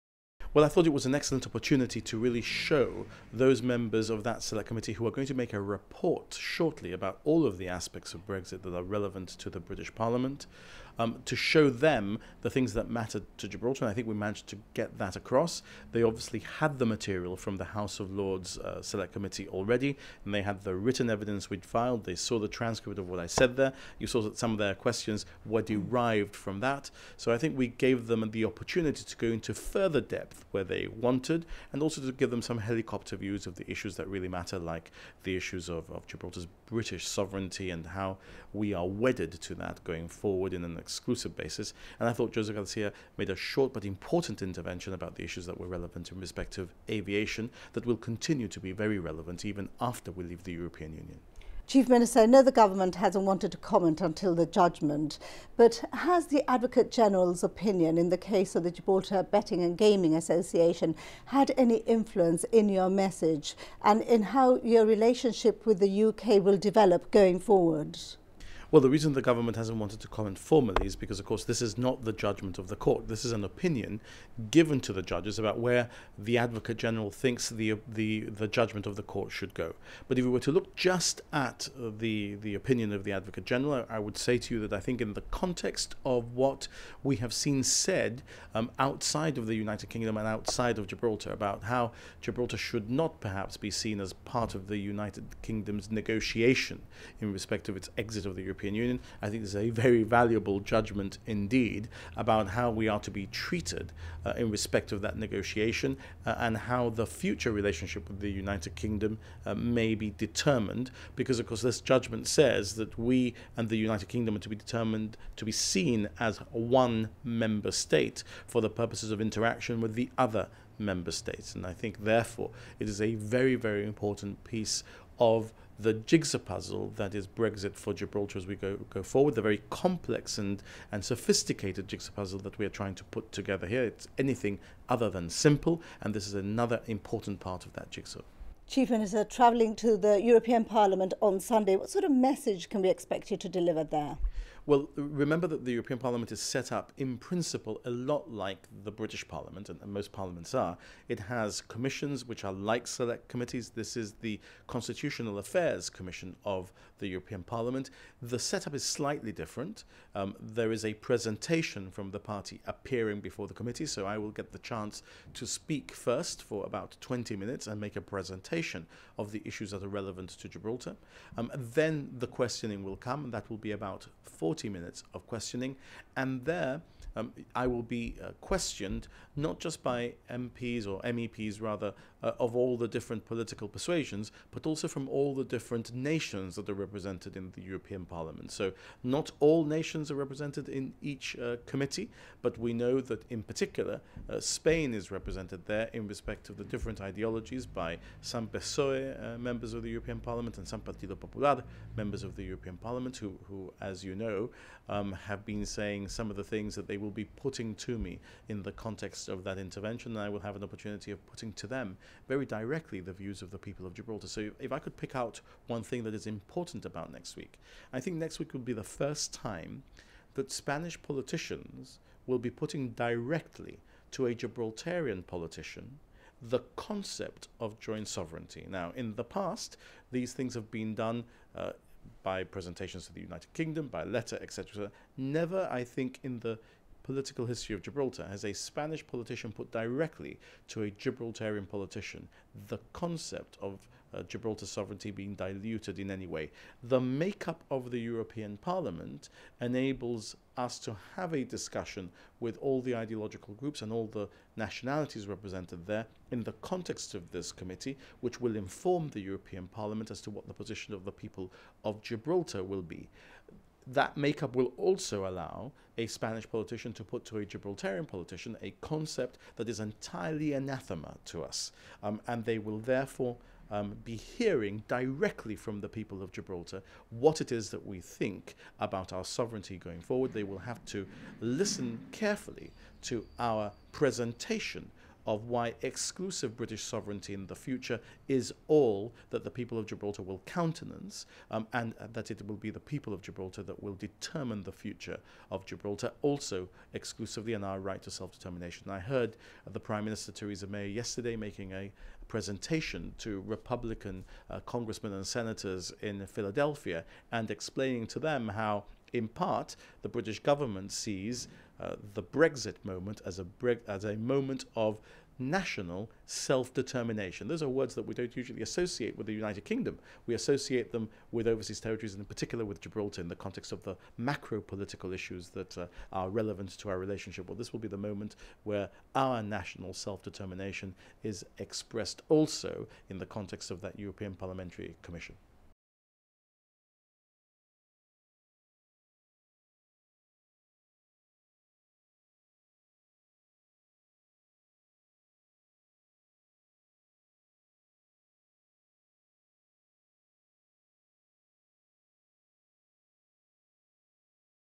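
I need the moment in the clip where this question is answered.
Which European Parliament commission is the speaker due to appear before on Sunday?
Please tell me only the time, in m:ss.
2:34.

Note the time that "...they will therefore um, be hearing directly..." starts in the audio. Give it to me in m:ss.
4:32.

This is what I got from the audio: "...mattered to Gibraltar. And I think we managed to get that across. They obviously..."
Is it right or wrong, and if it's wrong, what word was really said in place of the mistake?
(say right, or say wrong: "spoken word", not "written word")
right.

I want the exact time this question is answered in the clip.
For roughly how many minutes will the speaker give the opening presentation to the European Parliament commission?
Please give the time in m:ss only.
2:47.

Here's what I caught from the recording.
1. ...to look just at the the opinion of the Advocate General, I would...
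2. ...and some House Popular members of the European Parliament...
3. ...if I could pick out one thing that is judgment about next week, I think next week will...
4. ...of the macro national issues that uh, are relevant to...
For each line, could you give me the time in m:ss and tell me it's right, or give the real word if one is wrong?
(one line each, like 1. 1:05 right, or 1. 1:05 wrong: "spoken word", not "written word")
1. 1:20 right
2. 3:20 wrong: "Partido", not "House"
3. 3:34 wrong: "important", not "judgment"
4. 5:23 wrong: "political", not "national".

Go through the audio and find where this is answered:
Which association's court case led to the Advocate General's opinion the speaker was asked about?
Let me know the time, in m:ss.
0:58.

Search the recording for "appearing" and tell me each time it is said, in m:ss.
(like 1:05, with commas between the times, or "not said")
2:42.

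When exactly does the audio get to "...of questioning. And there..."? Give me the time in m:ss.
2:55.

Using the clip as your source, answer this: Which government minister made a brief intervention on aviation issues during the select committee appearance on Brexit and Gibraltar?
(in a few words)
Joseph Garcia.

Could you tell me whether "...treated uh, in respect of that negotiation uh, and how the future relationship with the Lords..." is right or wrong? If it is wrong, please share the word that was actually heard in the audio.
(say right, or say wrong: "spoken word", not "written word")
wrong: "United", not "Lords".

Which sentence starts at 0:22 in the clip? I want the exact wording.
They saw the transcript of what I said there.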